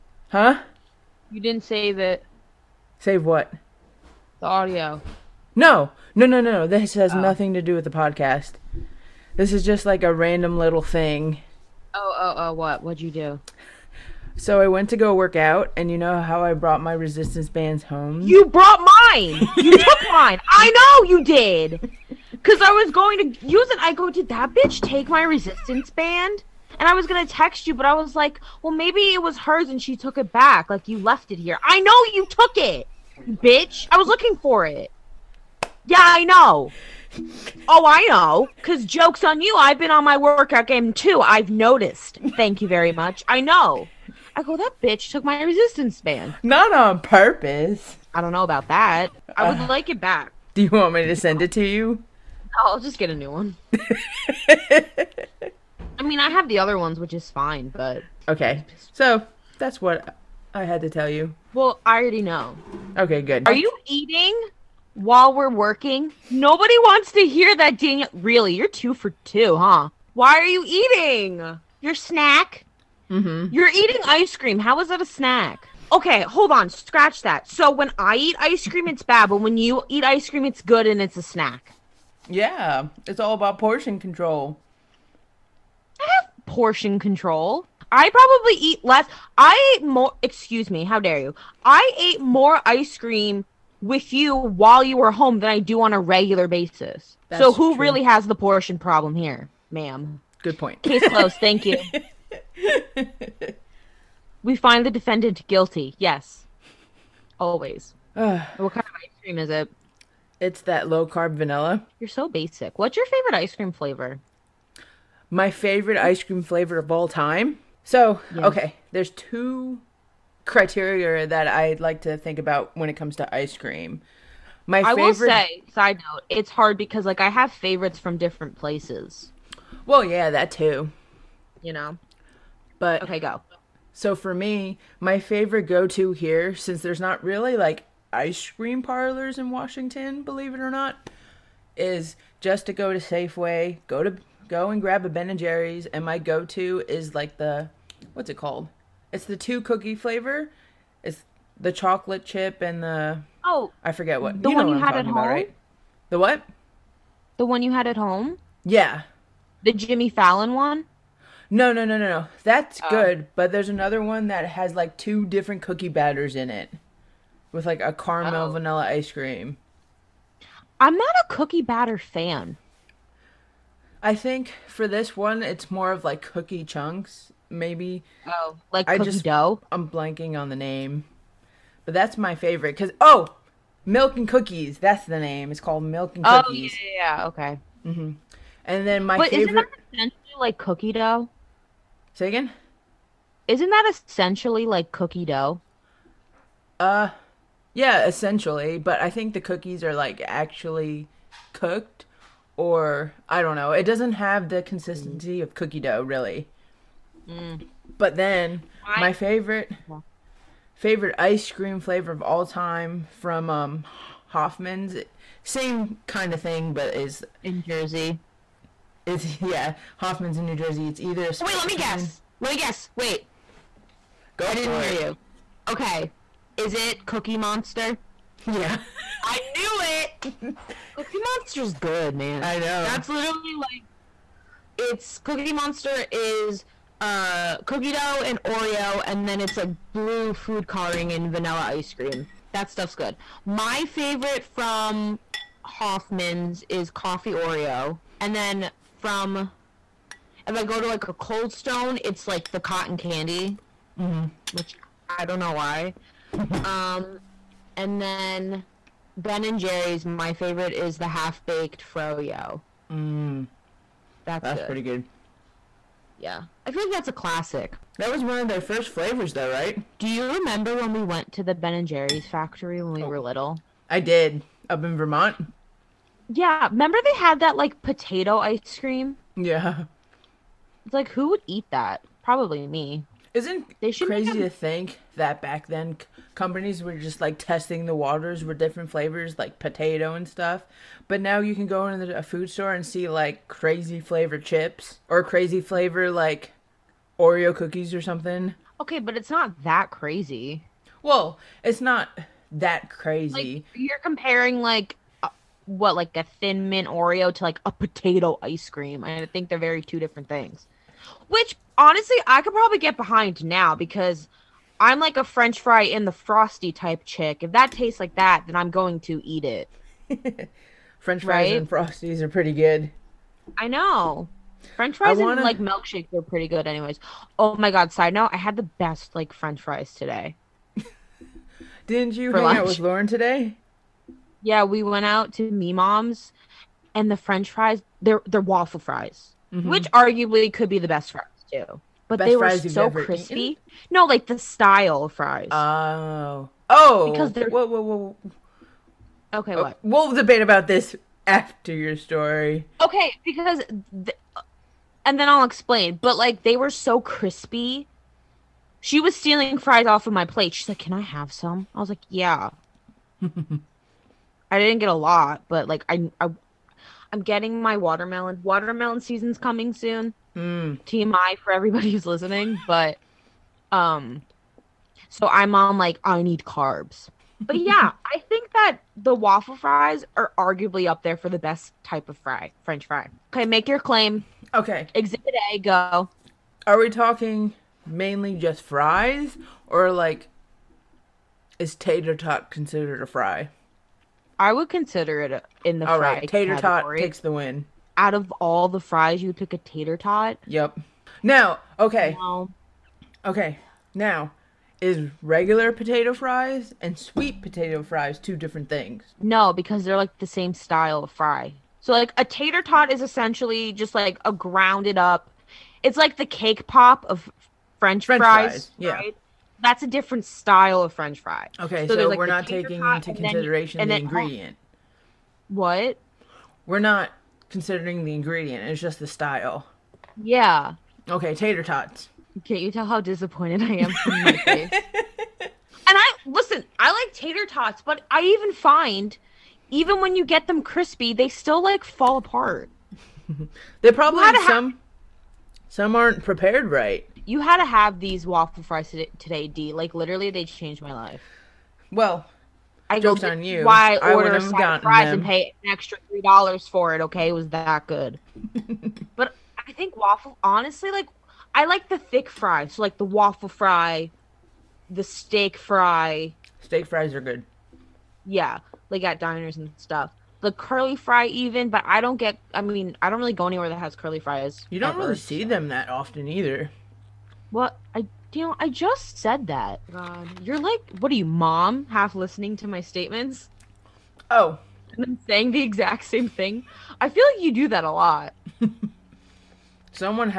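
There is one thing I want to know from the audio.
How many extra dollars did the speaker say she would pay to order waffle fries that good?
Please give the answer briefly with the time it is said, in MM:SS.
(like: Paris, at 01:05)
3, at 07:36.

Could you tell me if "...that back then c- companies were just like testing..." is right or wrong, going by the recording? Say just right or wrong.
right.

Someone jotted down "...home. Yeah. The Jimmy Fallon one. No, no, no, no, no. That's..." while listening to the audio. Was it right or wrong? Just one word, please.
right.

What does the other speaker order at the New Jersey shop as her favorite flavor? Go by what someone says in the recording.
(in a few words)
Coffee Oreo.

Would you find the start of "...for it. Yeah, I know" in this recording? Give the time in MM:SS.
00:34.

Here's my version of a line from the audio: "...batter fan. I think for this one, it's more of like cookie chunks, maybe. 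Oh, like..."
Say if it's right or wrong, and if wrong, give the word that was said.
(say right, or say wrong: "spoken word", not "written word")
right.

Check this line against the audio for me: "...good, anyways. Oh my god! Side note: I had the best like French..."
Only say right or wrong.
right.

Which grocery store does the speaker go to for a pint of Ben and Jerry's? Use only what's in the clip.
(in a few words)
Safeway.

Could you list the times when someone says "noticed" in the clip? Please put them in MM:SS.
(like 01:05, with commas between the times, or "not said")
00:41.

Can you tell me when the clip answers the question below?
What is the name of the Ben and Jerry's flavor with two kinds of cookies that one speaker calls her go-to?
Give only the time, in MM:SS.
03:05.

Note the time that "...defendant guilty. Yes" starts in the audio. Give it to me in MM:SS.
01:44.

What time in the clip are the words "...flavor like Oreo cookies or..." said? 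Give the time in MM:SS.
04:55.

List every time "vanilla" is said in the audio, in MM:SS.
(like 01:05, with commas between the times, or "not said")
01:51, 02:48, 04:01.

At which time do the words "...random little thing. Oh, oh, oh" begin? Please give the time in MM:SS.
00:10.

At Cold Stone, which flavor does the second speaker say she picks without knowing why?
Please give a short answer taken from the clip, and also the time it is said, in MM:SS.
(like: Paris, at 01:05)
Cotton candy, at 04:12.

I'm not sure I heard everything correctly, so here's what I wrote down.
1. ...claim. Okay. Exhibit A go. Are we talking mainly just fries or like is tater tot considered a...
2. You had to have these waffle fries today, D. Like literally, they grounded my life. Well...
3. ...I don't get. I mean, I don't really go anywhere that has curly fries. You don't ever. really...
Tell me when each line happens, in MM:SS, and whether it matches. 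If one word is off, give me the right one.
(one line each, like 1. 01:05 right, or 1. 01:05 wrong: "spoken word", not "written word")
1. 06:23 right
2. 07:27 wrong: "changed", not "grounded"
3. 07:51 right.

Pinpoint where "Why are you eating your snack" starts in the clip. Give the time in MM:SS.
01:10.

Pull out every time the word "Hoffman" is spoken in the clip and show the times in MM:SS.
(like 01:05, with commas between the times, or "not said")
03:34, 03:39, 04:05.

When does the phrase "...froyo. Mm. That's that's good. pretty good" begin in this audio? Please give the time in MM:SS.
04:21.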